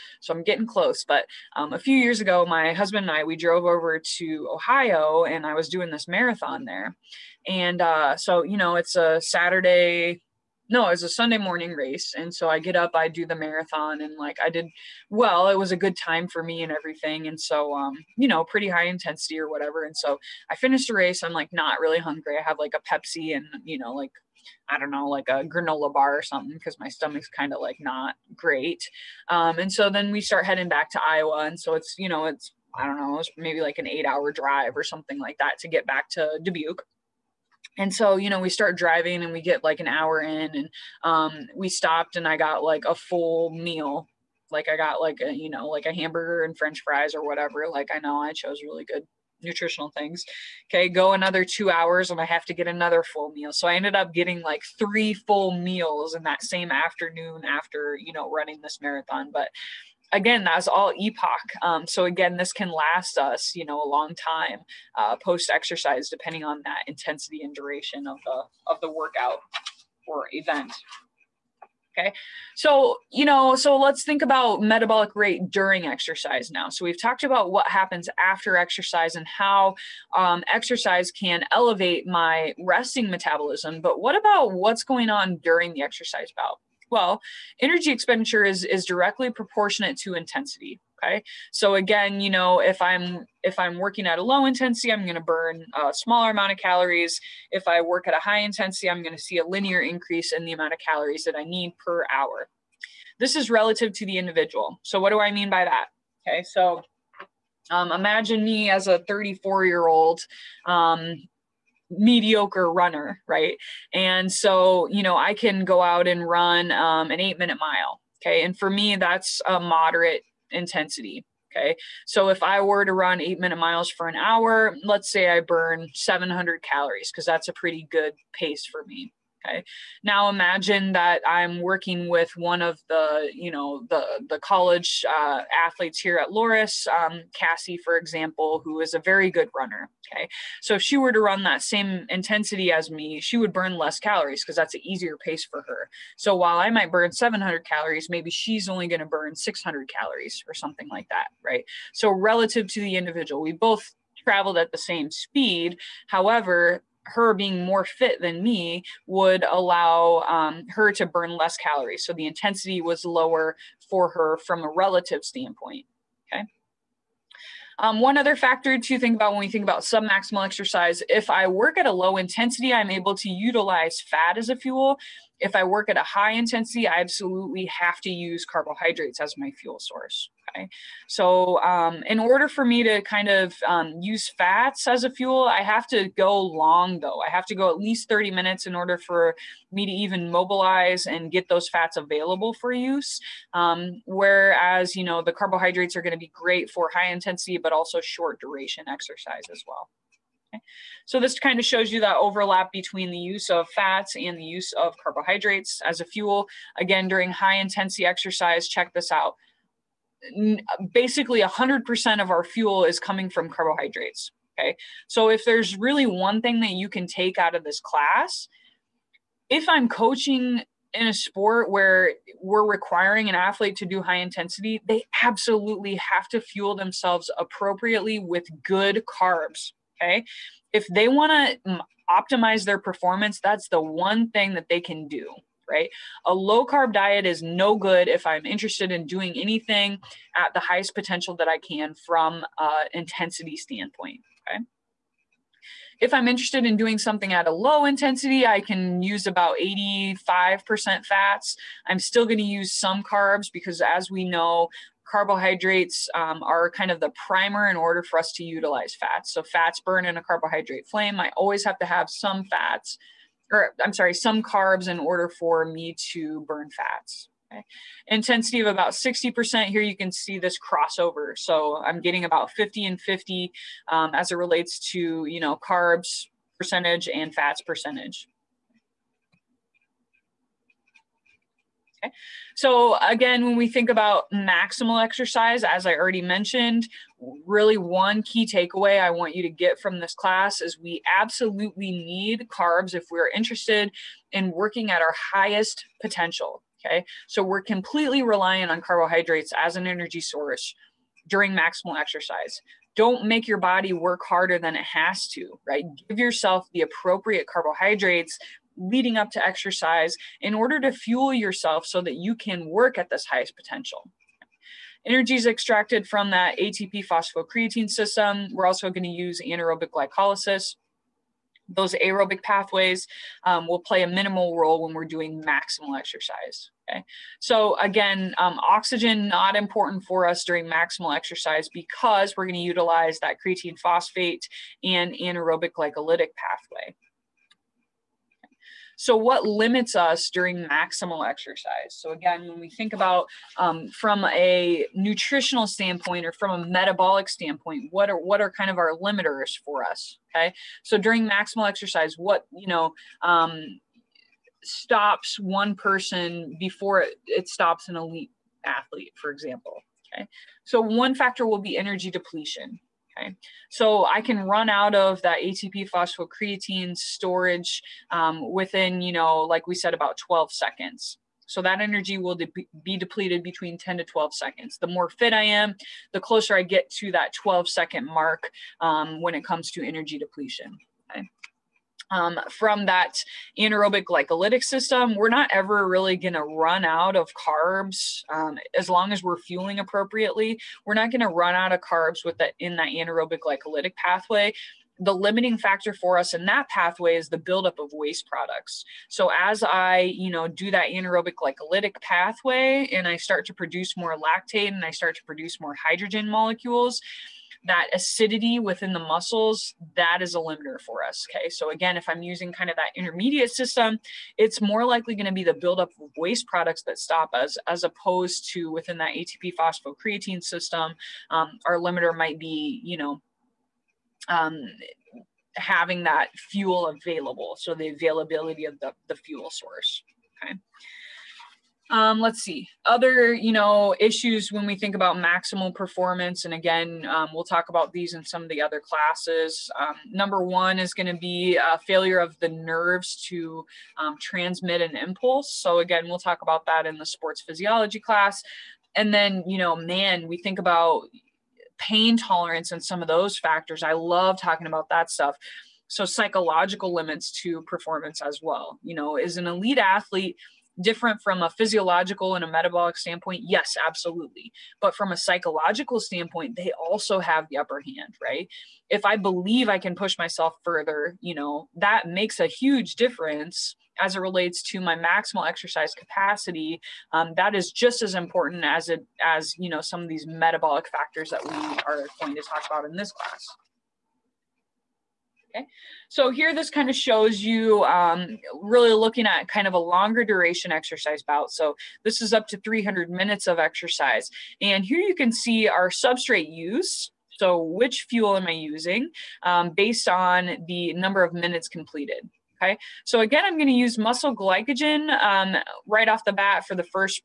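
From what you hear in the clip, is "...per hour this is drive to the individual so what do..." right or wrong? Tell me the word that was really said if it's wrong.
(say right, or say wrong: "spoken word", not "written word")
wrong: "relative", not "drive".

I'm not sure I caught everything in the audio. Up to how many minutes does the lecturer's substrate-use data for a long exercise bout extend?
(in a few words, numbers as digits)
300.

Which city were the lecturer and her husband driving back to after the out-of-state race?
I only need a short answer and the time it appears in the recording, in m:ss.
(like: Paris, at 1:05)
Dubuque, at 0:36.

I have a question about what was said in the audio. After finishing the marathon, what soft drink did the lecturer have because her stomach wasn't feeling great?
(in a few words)
Pepsi.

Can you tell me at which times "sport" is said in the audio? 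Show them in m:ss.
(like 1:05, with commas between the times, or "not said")
3:41, 7:27.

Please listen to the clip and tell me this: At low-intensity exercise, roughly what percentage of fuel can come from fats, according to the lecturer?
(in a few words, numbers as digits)
85%.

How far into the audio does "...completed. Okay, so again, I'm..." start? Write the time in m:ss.
8:21.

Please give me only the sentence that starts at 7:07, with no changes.
So the availability of the, the fuel source.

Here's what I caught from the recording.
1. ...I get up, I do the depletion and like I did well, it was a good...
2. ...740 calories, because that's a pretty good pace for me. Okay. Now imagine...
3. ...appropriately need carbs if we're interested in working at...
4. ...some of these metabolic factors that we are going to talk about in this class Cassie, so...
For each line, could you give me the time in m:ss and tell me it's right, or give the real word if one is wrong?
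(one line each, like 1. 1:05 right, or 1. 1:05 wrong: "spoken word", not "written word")
1. 0:12 wrong: "marathon", not "depletion"
2. 2:05 wrong: "700", not "740"
3. 4:51 wrong: "absolutely", not "appropriately"
4. 7:59 wrong: "Okay", not "Cassie".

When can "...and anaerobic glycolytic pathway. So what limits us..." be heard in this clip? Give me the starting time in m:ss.
5:34.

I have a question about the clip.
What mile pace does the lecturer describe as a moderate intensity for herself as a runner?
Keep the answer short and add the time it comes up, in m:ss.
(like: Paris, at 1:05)
8 minute mile, at 1:57.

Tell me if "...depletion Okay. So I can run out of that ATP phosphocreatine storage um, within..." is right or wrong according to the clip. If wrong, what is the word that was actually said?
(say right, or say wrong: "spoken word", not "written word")
right.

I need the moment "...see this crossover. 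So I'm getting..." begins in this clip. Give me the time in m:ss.
4:30.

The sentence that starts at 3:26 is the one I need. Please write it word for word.
Again, during high intensity exercise, check this out.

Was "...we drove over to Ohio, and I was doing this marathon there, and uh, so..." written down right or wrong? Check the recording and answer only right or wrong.
right.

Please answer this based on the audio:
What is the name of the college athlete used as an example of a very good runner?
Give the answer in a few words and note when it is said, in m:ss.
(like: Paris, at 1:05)
Cassie, at 2:17.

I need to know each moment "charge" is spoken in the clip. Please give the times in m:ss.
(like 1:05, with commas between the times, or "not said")
not said.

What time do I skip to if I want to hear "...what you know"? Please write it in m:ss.
5:52.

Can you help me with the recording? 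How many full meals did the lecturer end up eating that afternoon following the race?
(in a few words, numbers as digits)
3.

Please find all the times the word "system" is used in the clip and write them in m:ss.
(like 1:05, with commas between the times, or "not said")
5:17, 6:24, 6:53, 7:00.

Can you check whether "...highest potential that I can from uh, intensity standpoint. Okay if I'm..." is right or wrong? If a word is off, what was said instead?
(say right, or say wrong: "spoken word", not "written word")
right.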